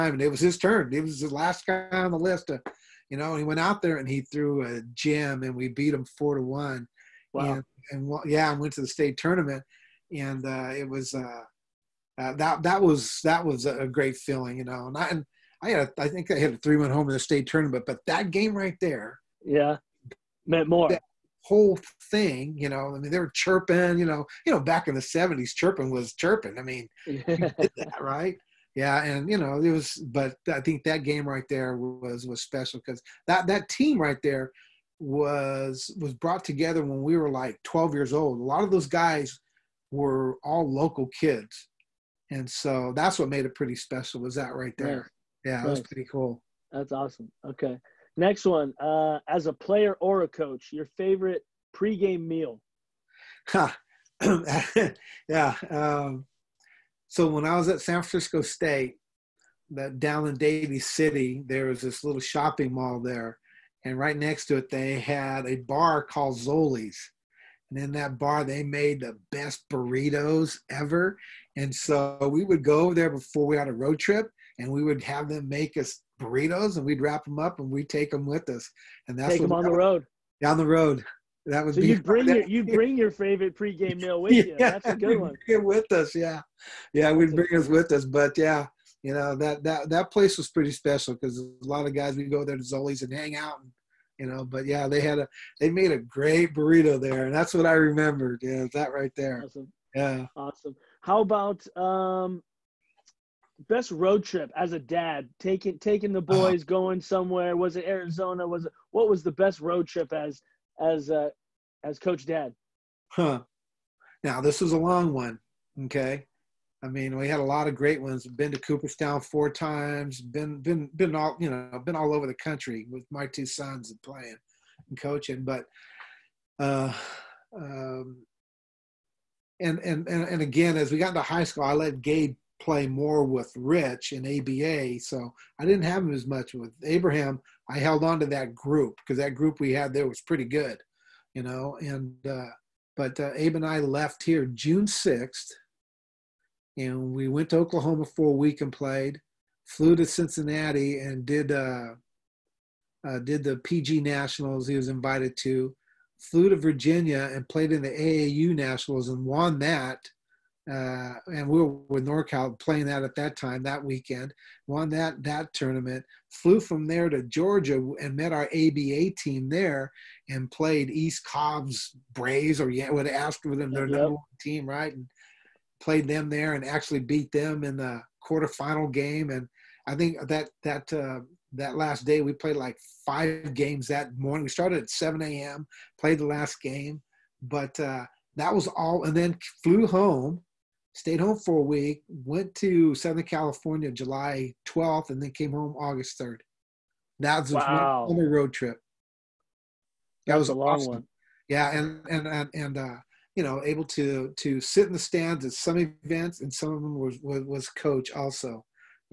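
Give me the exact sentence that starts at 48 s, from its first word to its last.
Uh, as a player or a coach, your favorite pregame meal?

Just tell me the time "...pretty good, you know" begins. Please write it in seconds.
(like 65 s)
140 s.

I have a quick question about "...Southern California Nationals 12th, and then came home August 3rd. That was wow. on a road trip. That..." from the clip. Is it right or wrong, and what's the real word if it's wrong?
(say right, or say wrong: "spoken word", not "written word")
wrong: "July", not "Nationals".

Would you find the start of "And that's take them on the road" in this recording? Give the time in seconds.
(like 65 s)
79 s.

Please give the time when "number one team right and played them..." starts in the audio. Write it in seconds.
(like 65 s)
173 s.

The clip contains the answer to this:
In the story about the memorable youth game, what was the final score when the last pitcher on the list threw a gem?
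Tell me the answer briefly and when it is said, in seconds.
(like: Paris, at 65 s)
4 to 1, at 6 s.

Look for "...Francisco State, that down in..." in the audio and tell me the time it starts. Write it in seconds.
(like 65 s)
58 s.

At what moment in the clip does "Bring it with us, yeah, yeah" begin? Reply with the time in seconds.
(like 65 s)
85 s.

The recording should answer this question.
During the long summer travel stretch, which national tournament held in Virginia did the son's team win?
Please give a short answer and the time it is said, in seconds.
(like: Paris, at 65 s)
AAU Nationals, at 157 s.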